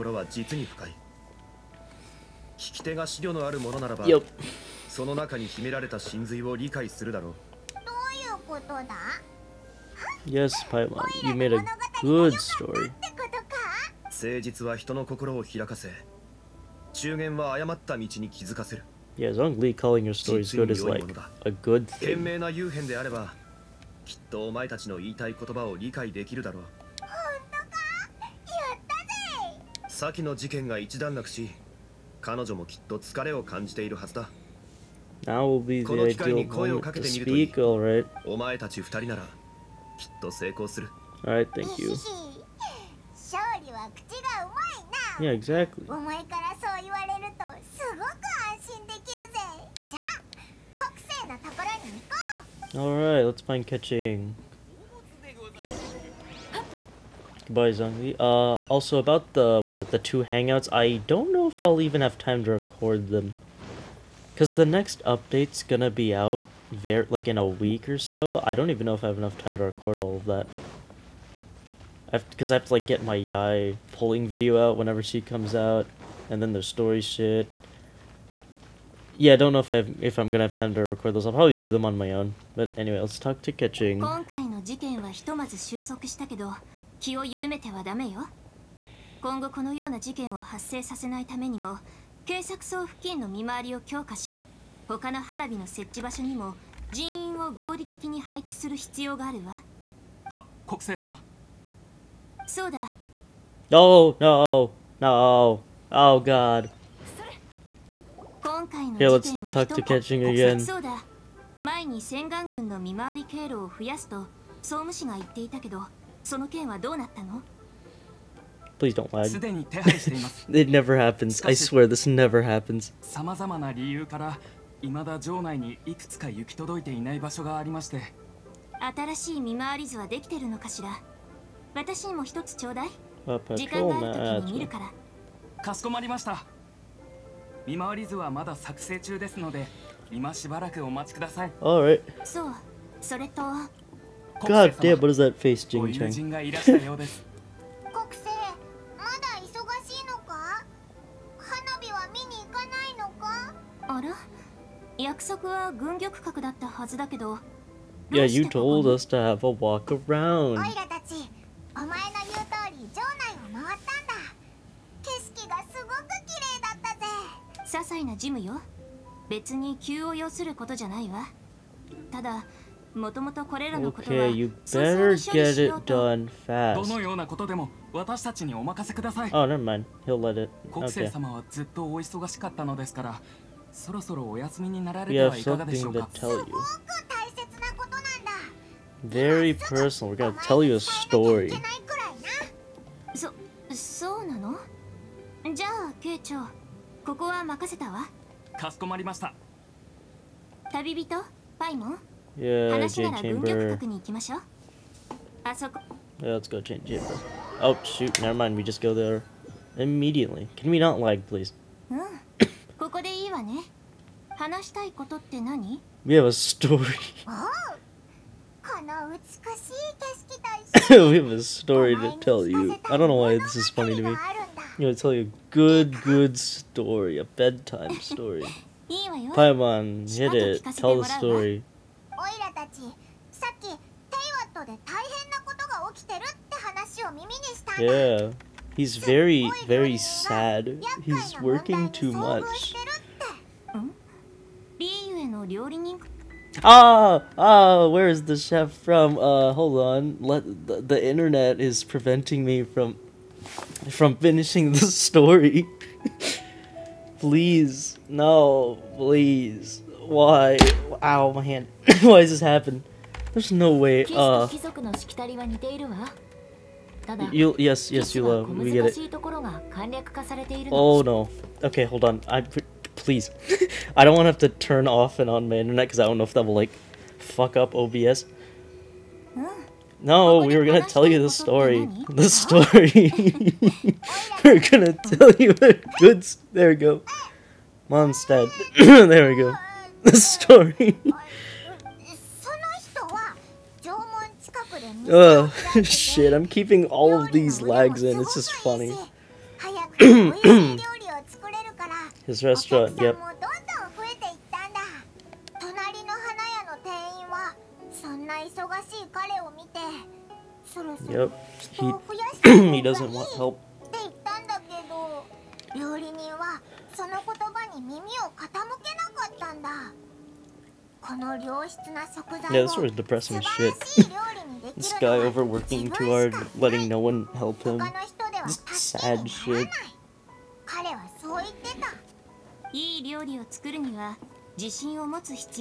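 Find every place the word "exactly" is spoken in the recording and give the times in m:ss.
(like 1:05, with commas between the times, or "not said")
0:45.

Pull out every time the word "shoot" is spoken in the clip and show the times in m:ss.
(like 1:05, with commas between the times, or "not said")
3:27.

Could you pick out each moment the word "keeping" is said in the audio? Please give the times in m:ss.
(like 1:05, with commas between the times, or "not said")
4:56.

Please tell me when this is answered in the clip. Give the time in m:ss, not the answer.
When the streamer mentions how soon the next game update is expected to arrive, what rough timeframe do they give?
1:07.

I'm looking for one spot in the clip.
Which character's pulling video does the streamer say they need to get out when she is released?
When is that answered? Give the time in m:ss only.
1:13.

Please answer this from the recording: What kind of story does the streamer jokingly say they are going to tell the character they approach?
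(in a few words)
a bedtime story.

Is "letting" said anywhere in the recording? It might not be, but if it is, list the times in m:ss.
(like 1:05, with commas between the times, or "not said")
5:26.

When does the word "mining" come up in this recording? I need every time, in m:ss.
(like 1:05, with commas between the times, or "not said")
not said.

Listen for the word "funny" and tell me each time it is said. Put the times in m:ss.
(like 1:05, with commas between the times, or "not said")
3:43, 4:58.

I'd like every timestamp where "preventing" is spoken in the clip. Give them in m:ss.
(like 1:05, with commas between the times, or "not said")
4:11.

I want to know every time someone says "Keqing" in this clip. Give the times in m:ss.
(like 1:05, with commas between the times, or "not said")
0:53, 1:23.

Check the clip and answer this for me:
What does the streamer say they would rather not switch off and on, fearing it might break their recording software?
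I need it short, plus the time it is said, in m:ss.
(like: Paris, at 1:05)
the internet, at 4:35.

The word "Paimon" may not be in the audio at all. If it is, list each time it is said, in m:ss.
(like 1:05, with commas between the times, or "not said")
0:10, 3:49.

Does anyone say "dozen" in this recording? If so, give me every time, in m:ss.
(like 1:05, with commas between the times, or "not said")
not said.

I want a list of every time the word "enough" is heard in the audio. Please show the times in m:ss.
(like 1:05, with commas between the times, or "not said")
1:09.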